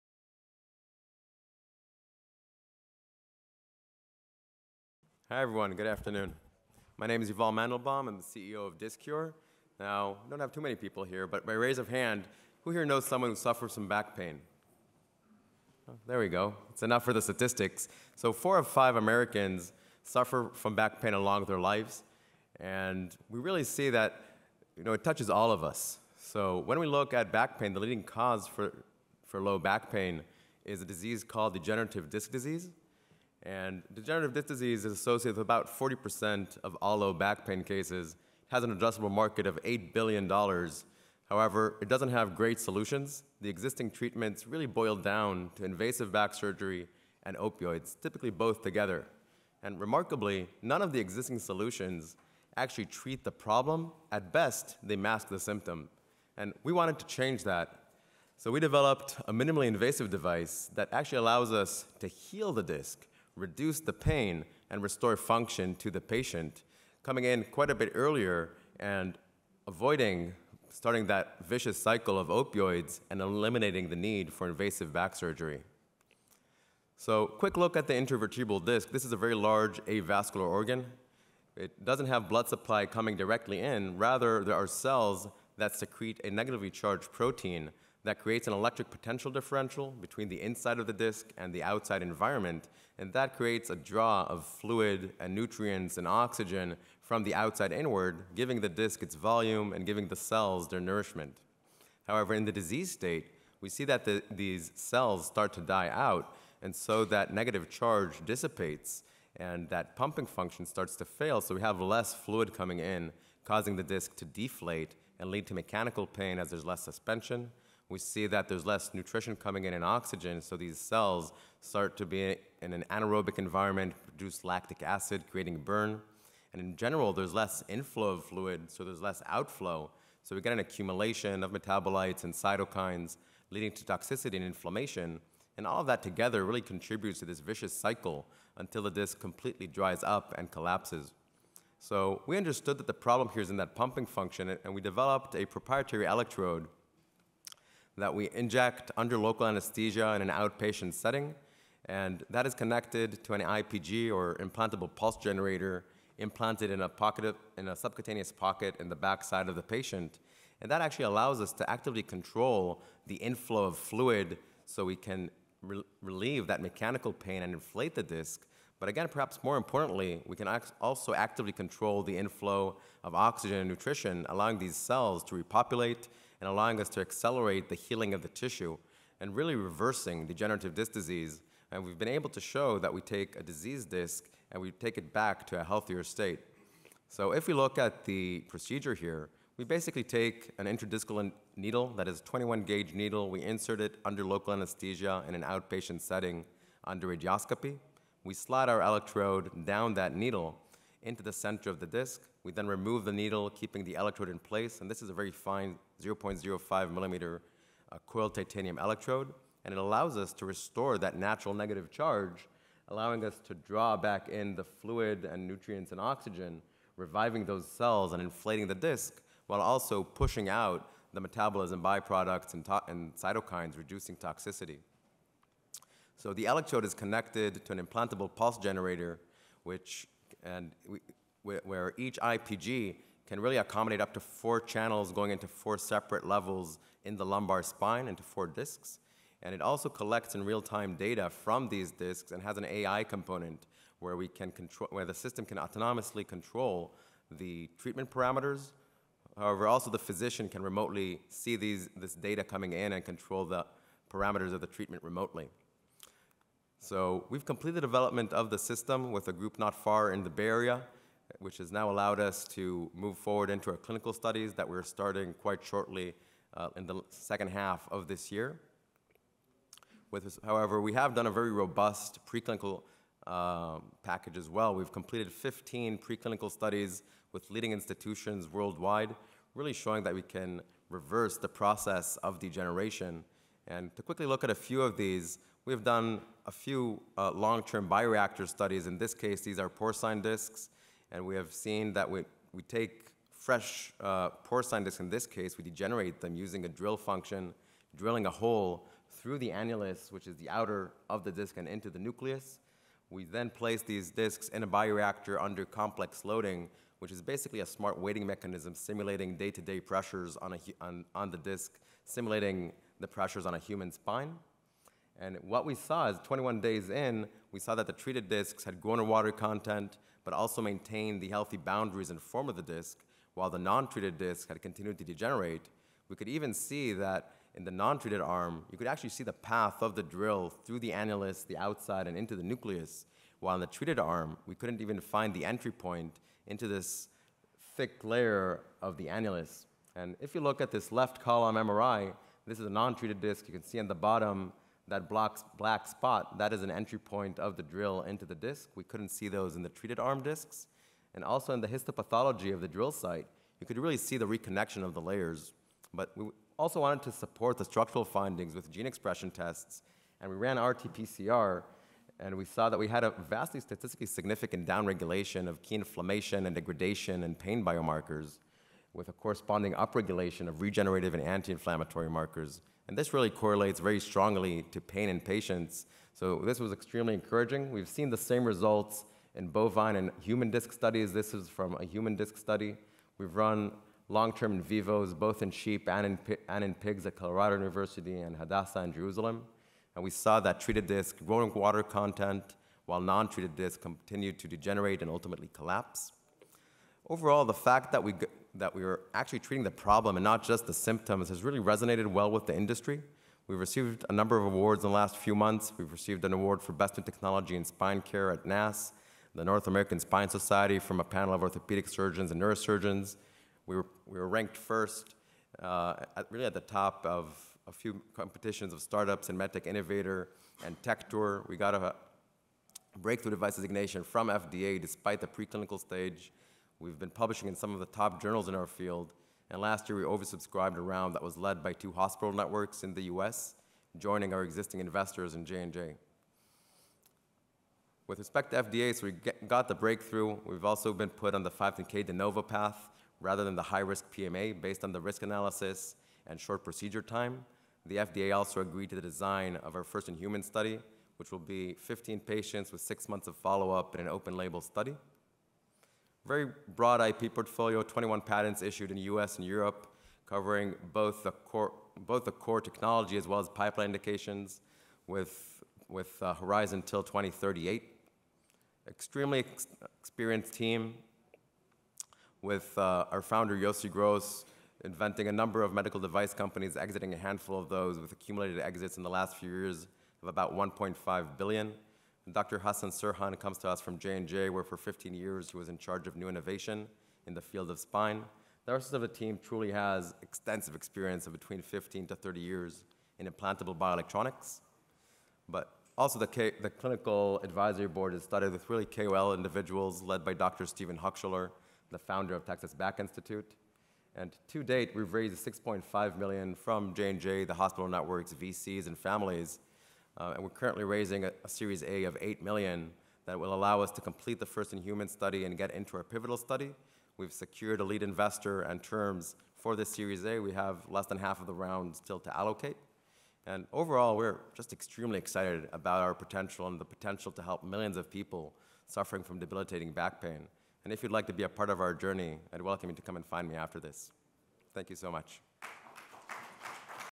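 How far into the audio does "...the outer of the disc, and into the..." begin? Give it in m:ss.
5:00.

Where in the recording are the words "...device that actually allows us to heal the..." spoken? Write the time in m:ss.
1:00.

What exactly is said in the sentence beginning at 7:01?
We got a breakthrough device designation from FDA despite the preclinical stage.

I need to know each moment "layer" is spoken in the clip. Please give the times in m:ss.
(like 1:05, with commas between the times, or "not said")
5:38, 5:55.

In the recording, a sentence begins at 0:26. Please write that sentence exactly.
So, when we look at back pain, the leading cause for, for low back pain is a disease called degenerative disc disease.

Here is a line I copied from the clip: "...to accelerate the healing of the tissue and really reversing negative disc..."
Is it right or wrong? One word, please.
wrong.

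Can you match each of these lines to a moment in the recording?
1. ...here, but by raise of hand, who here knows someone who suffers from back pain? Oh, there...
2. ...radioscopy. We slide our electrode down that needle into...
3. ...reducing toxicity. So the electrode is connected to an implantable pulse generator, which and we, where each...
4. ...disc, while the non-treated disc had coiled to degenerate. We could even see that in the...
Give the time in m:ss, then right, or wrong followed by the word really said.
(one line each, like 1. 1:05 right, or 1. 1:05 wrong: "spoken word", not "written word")
1. 0:11 right
2. 3:17 right
3. 3:43 right
4. 5:22 wrong: "continued", not "coiled".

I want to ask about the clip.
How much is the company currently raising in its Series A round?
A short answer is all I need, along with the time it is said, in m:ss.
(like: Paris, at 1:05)
$8 million, at 8:32.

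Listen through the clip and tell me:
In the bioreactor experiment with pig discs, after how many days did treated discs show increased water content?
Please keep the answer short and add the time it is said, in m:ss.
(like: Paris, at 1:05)
21 days, at 5:16.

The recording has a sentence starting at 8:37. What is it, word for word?
We've secured a lead investor and terms for this Series A.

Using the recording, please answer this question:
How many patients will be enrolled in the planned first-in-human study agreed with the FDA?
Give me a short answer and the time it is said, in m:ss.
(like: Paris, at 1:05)
15, at 7:31.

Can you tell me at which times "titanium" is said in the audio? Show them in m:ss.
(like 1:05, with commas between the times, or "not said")
3:28.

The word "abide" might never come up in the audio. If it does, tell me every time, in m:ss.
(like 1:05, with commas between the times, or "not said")
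not said.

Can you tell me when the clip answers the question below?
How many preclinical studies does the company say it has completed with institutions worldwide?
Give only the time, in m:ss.
4:35.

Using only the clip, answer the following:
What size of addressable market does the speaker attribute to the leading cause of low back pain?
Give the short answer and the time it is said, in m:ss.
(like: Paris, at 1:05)
$8 billion, at 0:39.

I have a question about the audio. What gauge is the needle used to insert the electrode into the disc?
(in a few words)
21 gauge.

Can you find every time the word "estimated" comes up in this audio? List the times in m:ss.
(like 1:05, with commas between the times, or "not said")
not said.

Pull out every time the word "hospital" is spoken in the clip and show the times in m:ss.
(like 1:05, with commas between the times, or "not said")
7:11, 8:27.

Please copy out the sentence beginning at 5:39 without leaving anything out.
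And if you look at this left column MRI, this is a non-treated disc.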